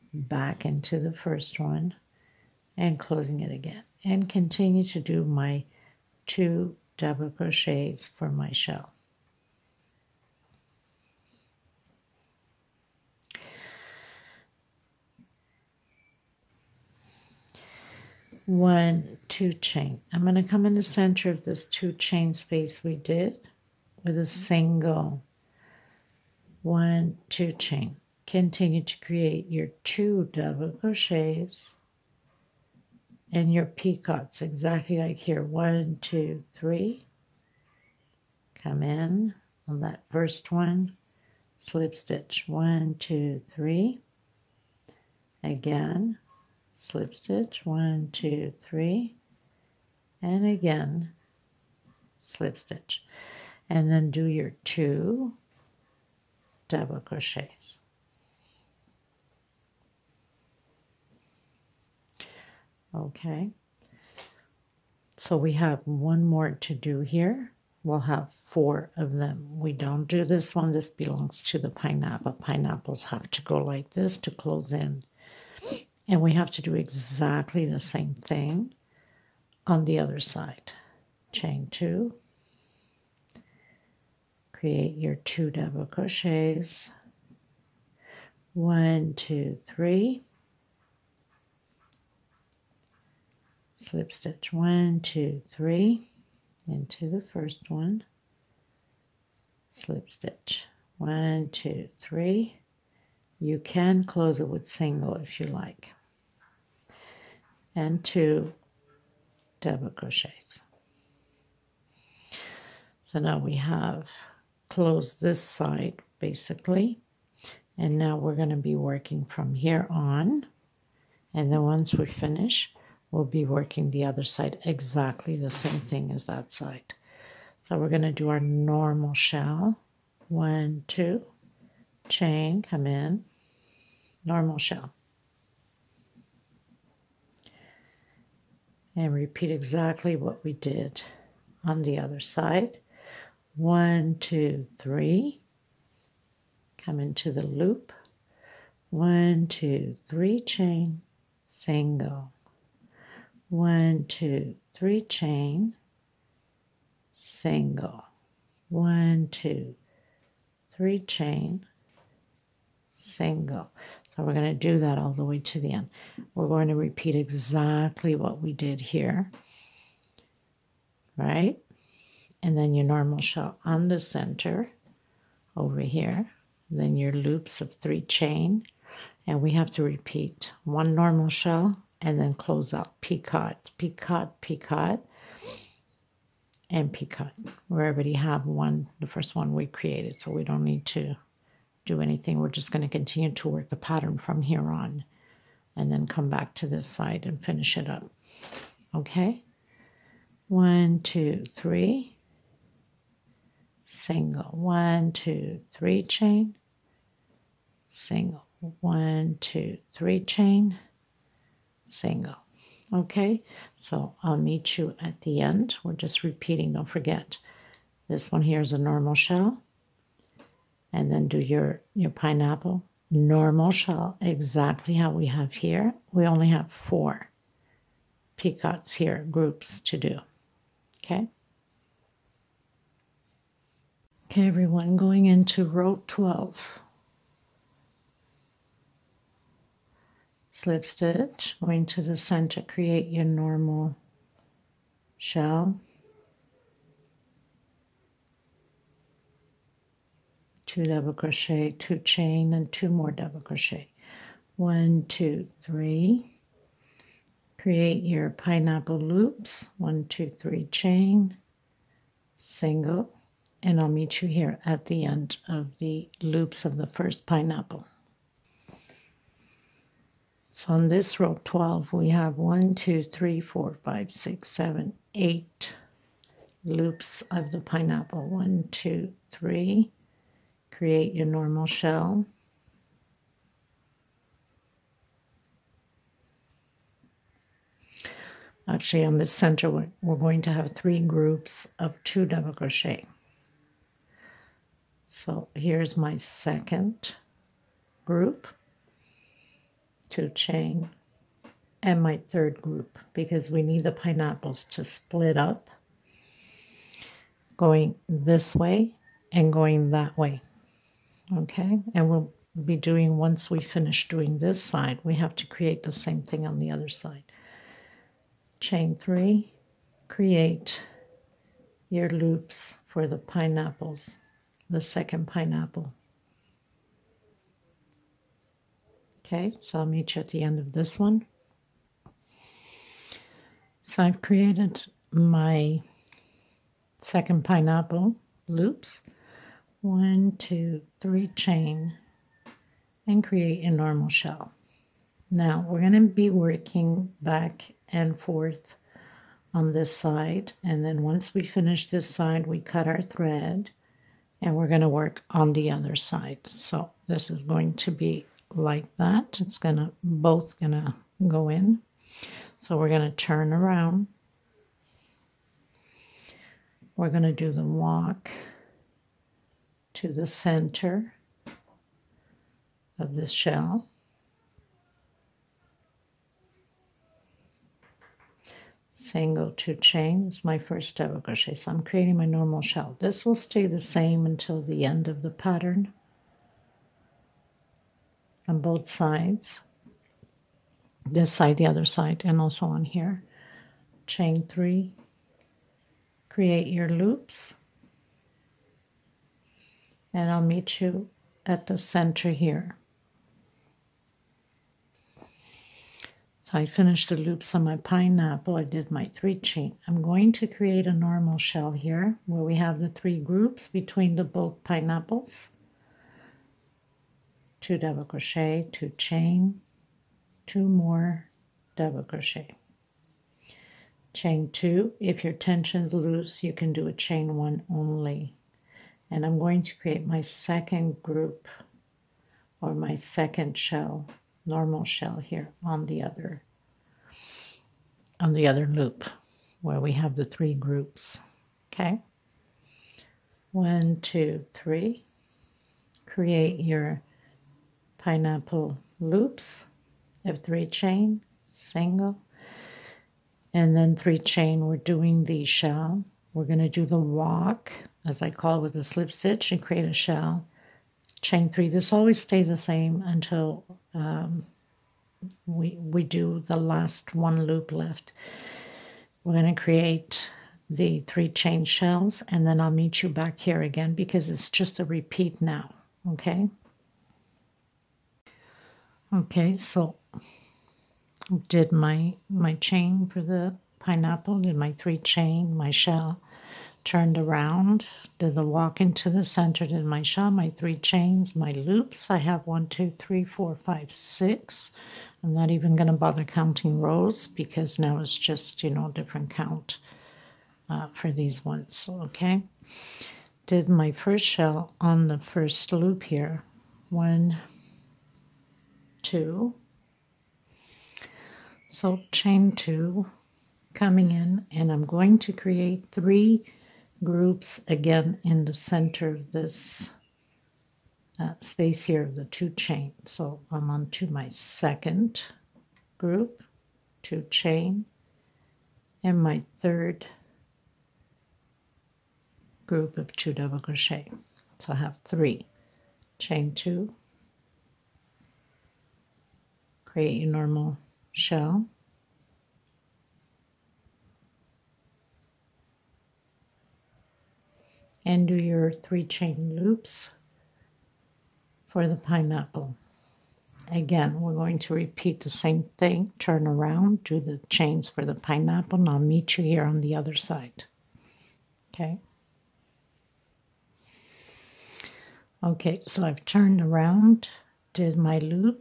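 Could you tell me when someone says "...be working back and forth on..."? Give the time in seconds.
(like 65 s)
346 s.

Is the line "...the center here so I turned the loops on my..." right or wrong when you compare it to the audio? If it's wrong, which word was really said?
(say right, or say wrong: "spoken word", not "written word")
wrong: "finished", not "turned".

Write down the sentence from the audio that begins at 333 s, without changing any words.
So I've created my second pineapple loops.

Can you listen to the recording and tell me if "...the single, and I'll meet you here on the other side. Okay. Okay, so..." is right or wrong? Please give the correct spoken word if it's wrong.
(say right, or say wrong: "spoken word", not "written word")
wrong: "pineapple", not "single".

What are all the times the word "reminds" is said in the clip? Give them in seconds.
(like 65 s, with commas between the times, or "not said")
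not said.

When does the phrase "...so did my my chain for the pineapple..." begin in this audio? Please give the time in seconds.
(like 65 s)
479 s.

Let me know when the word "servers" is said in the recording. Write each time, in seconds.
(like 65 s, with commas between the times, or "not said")
not said.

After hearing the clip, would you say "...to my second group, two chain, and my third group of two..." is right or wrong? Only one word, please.
right.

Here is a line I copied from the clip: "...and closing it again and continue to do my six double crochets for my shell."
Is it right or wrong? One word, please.
wrong.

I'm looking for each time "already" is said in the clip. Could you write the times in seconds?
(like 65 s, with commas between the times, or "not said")
187 s.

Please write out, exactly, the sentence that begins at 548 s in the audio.
And do your three chain loops for the pineapple.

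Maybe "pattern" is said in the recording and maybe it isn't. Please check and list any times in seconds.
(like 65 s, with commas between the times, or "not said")
193 s, 385 s.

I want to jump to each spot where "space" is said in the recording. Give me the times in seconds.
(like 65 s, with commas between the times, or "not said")
22 s, 521 s.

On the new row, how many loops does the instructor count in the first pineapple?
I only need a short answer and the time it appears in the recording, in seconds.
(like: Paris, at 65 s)
8, at 272 s.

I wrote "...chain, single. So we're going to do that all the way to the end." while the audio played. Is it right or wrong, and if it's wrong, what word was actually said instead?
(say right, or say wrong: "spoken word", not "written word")
right.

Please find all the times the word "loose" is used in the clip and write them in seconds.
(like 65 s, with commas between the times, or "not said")
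425 s.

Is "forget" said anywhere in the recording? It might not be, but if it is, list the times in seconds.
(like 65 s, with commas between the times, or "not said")
216 s.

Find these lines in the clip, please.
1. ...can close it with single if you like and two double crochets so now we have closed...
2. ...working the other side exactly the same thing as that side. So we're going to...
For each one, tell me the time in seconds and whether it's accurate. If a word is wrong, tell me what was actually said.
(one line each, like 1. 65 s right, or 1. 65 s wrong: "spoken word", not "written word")
1. 103 s right
2. 123 s right.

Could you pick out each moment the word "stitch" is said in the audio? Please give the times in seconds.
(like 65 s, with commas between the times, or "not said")
41 s, 47 s, 52 s, 94 s, 100 s, 240 s, 459 s.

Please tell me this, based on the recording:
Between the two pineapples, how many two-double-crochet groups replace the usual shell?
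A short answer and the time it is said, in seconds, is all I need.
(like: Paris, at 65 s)
3, at 290 s.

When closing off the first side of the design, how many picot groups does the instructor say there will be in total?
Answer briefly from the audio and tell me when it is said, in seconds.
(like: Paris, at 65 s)
4, at 67 s.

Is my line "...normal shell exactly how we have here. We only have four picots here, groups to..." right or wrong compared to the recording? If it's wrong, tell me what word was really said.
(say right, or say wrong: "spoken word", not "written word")
right.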